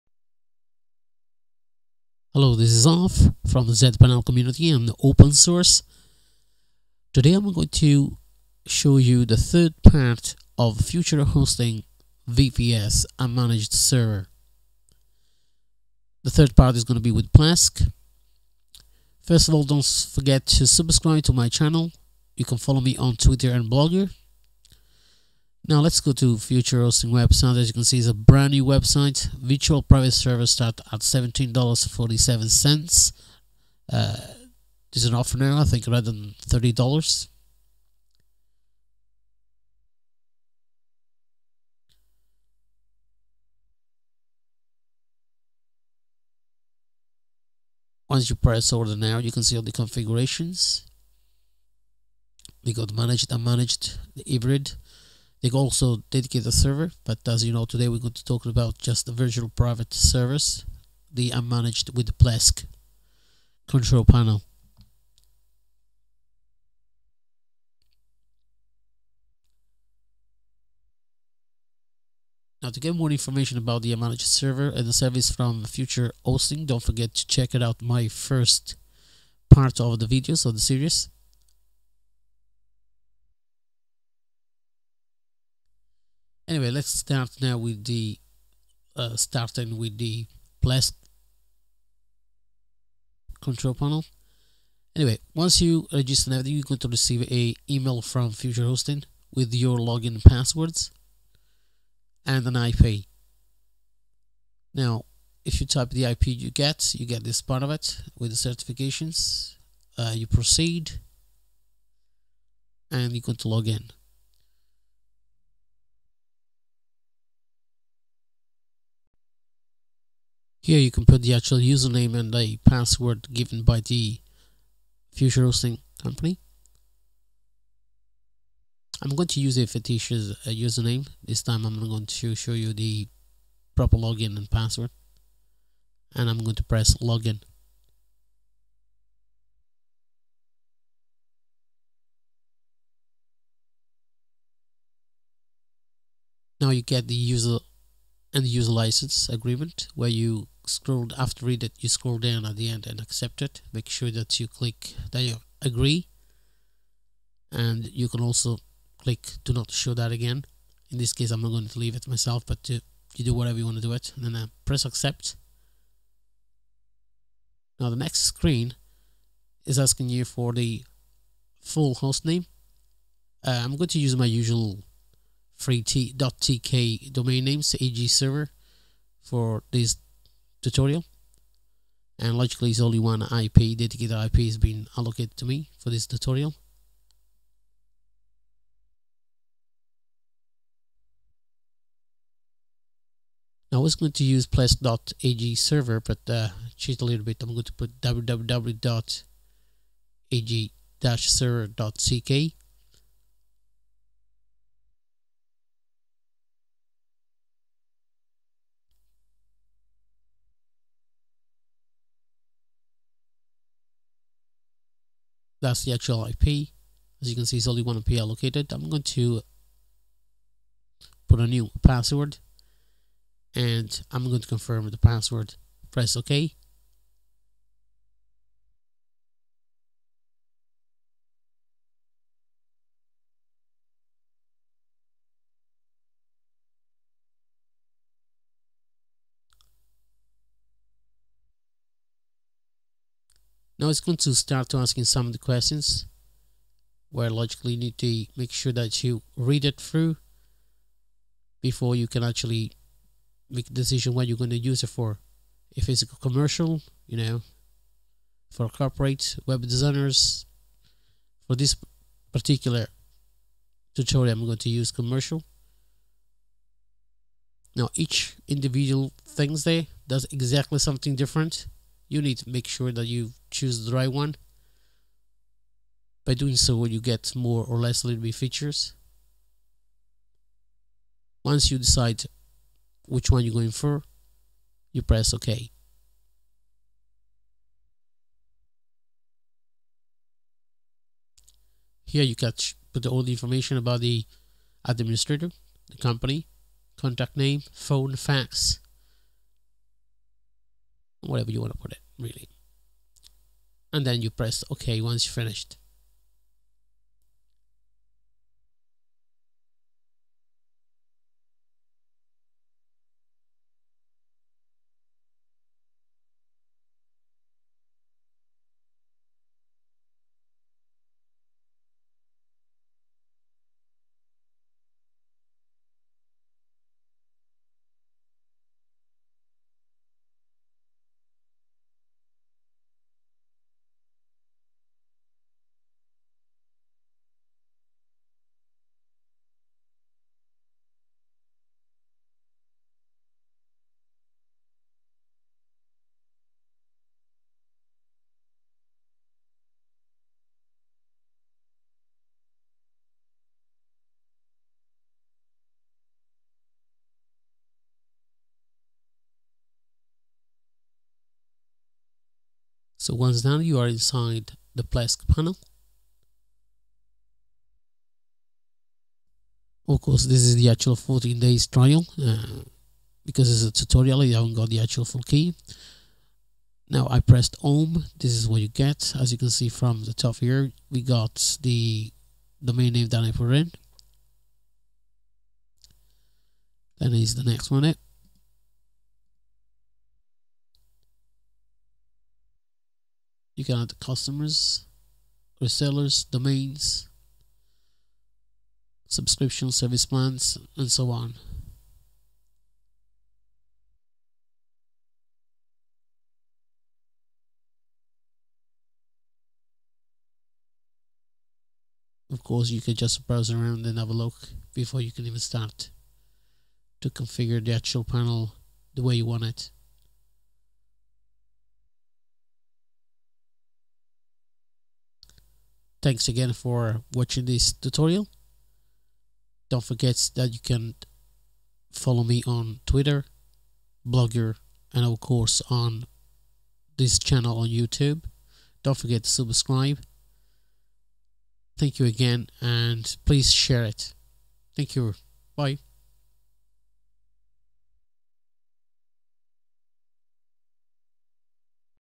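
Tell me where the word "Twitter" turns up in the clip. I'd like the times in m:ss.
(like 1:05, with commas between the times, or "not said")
0:23, 7:12.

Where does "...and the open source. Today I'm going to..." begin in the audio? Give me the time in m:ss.
0:04.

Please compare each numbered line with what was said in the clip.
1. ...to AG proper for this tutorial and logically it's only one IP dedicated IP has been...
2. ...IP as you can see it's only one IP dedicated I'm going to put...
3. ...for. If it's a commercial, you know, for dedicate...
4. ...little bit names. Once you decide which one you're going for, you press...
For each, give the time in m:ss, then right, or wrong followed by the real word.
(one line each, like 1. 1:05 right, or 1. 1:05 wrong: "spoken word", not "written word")
1. 2:57 wrong: "server", not "proper"
2. 3:36 wrong: "allocated", not "dedicated"
3. 4:14 wrong: "corporate", not "dedicate"
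4. 4:38 wrong: "features", not "names".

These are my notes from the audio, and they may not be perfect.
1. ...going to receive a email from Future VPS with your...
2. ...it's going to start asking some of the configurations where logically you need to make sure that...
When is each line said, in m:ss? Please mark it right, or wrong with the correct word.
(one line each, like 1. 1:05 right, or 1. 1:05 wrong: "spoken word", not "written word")
1. 1:36 wrong: "Hosting", not "VPS"
2. 4:03 wrong: "questions", not "configurations".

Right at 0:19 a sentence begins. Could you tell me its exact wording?
First of all, don't forget to subscribe to my channel.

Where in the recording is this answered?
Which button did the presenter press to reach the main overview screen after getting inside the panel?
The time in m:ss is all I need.
6:17.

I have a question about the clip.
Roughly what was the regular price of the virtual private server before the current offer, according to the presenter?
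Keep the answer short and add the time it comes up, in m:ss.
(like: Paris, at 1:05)
$30, at 0:36.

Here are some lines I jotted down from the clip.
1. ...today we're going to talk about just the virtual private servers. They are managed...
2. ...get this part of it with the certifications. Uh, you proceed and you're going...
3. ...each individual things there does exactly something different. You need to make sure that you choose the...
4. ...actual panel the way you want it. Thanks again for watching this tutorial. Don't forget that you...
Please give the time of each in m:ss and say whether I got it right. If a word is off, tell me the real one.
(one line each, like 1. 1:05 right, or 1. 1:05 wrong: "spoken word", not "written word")
1. 0:57 right
2. 1:47 right
3. 4:27 right
4. 6:57 right.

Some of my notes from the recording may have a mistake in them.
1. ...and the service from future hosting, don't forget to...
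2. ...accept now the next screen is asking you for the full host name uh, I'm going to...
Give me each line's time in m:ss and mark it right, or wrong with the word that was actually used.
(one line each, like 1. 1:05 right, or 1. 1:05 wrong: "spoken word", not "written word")
1. 1:14 right
2. 2:44 right.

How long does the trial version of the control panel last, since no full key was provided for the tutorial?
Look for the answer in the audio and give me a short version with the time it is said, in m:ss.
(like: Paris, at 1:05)
14 days, at 6:10.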